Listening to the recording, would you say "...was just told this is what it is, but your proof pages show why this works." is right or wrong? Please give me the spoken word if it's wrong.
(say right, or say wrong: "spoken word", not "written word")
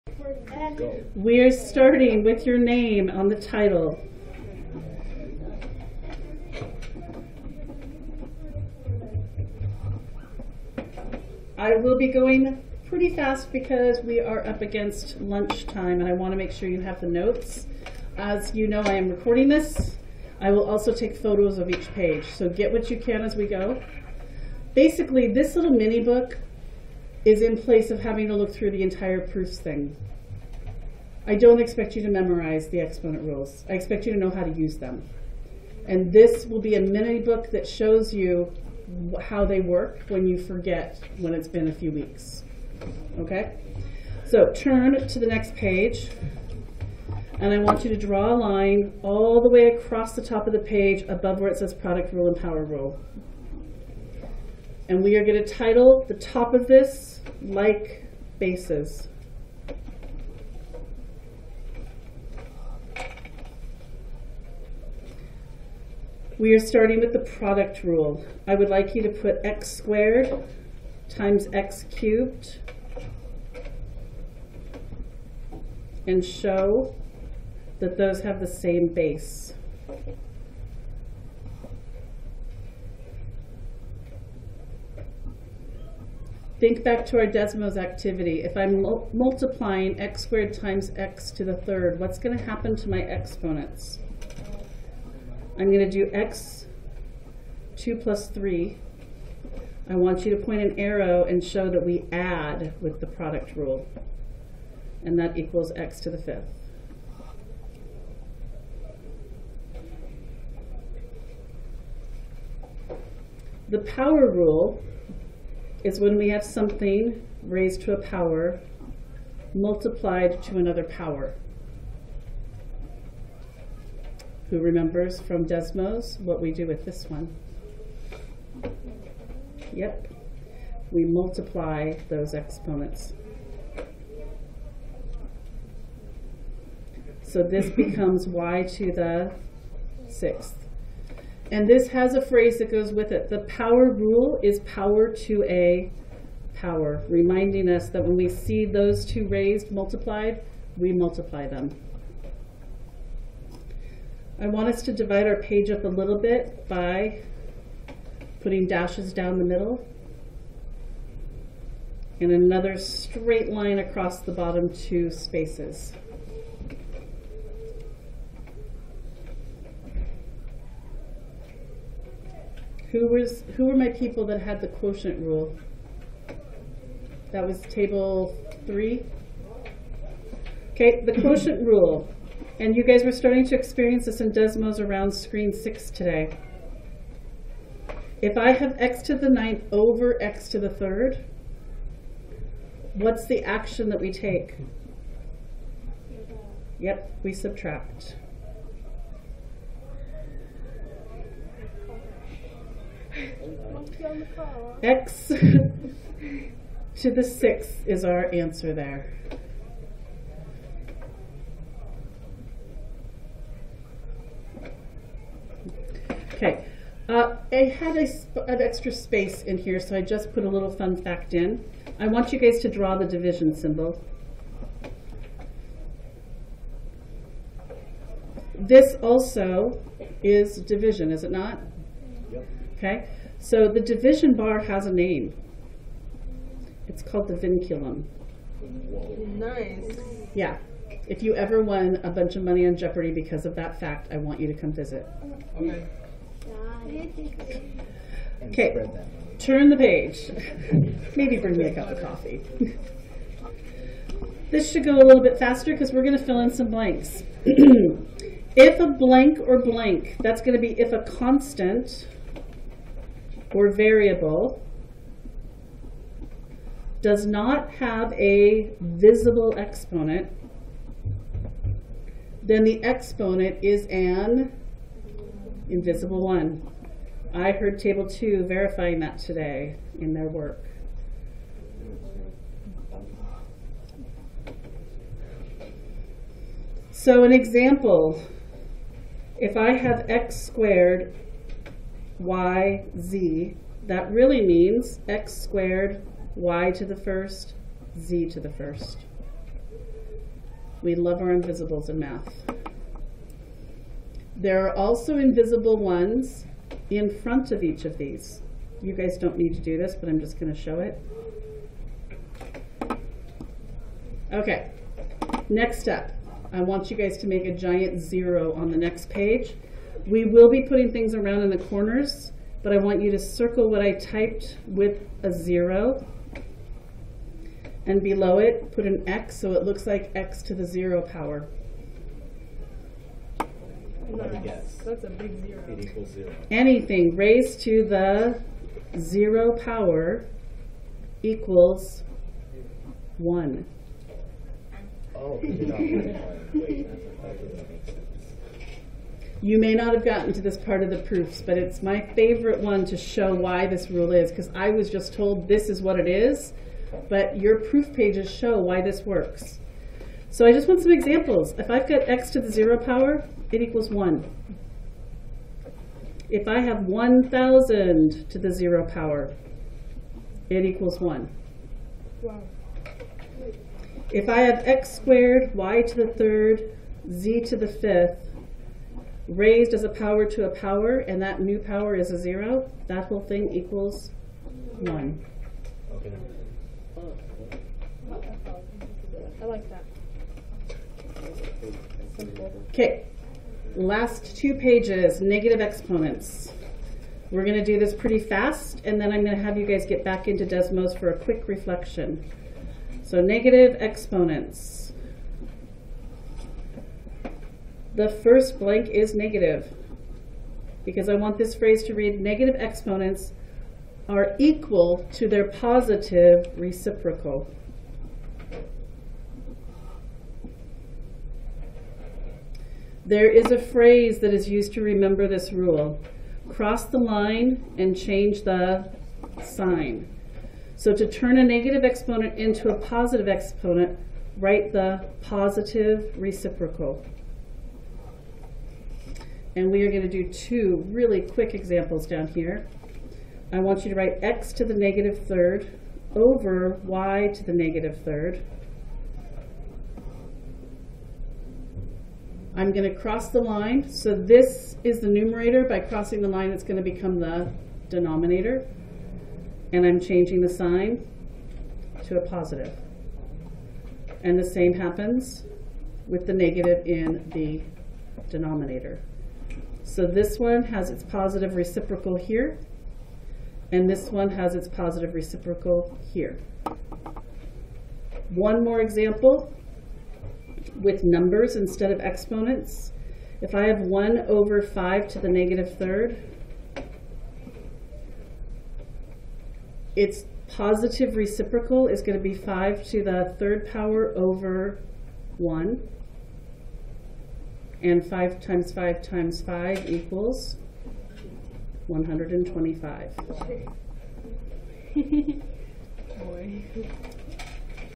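right.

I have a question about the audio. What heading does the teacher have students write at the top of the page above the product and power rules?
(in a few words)
Like bases.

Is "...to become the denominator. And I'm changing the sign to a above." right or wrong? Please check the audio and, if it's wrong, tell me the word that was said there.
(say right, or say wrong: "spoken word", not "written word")
wrong: "positive", not "above".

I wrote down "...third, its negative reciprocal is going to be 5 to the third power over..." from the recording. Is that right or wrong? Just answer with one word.
wrong.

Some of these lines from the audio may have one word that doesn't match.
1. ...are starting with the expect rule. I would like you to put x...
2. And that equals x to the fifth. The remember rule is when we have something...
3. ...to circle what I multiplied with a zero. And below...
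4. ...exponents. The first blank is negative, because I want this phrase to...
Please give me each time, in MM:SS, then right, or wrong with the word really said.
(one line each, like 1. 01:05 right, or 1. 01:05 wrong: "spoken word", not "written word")
1. 01:06 wrong: "product", not "expect"
2. 01:45 wrong: "power", not "remember"
3. 05:23 wrong: "typed", not "multiplied"
4. 06:43 right.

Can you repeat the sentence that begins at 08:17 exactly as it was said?
And 5 times 5 times 5 equals 125.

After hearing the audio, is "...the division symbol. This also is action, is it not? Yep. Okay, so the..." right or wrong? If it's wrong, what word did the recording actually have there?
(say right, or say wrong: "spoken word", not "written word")
wrong: "division", not "action".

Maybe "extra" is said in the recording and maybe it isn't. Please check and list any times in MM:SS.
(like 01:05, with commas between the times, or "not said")
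03:38.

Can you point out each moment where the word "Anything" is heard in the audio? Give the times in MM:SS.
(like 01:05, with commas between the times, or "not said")
05:36.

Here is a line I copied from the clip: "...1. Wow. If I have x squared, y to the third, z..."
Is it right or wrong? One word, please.
right.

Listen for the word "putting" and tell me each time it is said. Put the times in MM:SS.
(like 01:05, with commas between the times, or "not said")
02:38, 05:20.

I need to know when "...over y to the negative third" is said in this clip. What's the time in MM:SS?
07:26.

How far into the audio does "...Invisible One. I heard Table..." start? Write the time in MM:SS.
04:35.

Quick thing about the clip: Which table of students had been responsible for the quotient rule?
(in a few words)
Table three.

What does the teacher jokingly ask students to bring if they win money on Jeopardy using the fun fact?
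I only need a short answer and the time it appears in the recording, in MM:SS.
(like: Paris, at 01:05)
A cup of coffee, at 04:11.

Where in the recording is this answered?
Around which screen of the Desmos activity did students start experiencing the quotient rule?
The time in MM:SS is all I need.
03:05.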